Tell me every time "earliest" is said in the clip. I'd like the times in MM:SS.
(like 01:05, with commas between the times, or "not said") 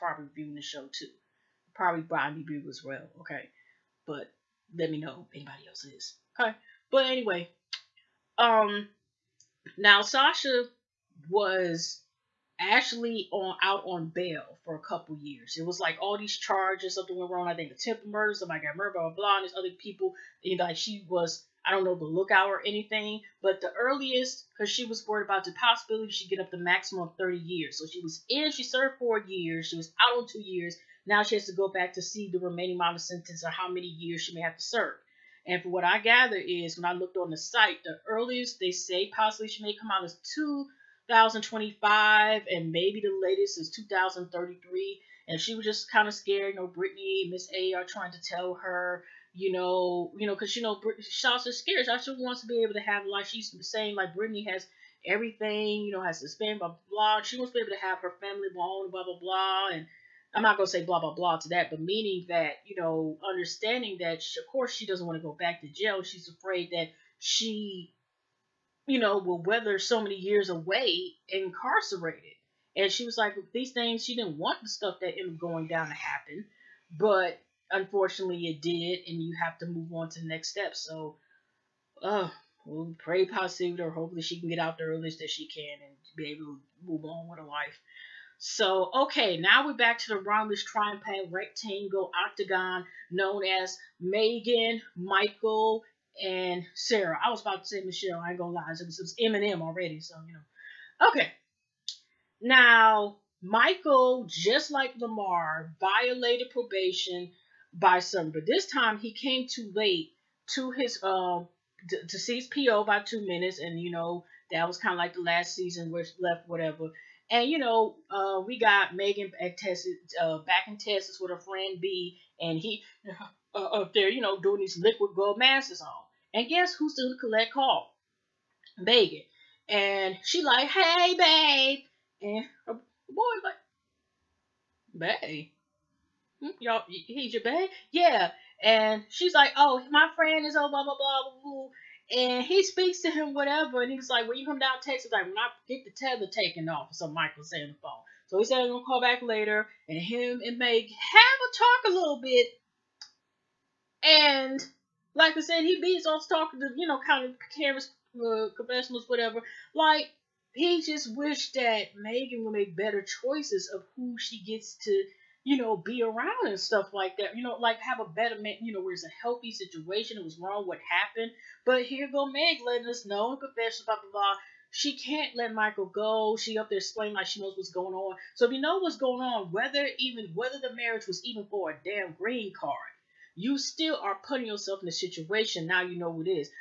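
00:23, 00:38, 01:24.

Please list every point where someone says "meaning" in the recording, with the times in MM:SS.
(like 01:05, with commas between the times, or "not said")
01:01.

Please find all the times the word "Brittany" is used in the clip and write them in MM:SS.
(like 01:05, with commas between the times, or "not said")
00:46, 00:54.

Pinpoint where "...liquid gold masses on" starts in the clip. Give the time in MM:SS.
02:04.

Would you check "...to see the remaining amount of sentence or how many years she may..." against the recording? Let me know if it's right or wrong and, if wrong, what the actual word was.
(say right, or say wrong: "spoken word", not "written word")
right.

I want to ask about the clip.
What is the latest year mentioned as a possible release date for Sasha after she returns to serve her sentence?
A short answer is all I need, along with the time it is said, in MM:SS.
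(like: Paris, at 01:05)
2033, at 00:43.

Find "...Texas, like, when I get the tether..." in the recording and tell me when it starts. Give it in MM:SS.
02:24.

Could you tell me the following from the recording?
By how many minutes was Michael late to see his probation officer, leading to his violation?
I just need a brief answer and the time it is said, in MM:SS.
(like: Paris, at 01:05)
2 minutes, at 01:53.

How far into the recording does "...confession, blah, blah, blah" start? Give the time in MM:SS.
02:53.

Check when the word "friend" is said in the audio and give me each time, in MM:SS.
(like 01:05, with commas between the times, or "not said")
02:01, 02:20.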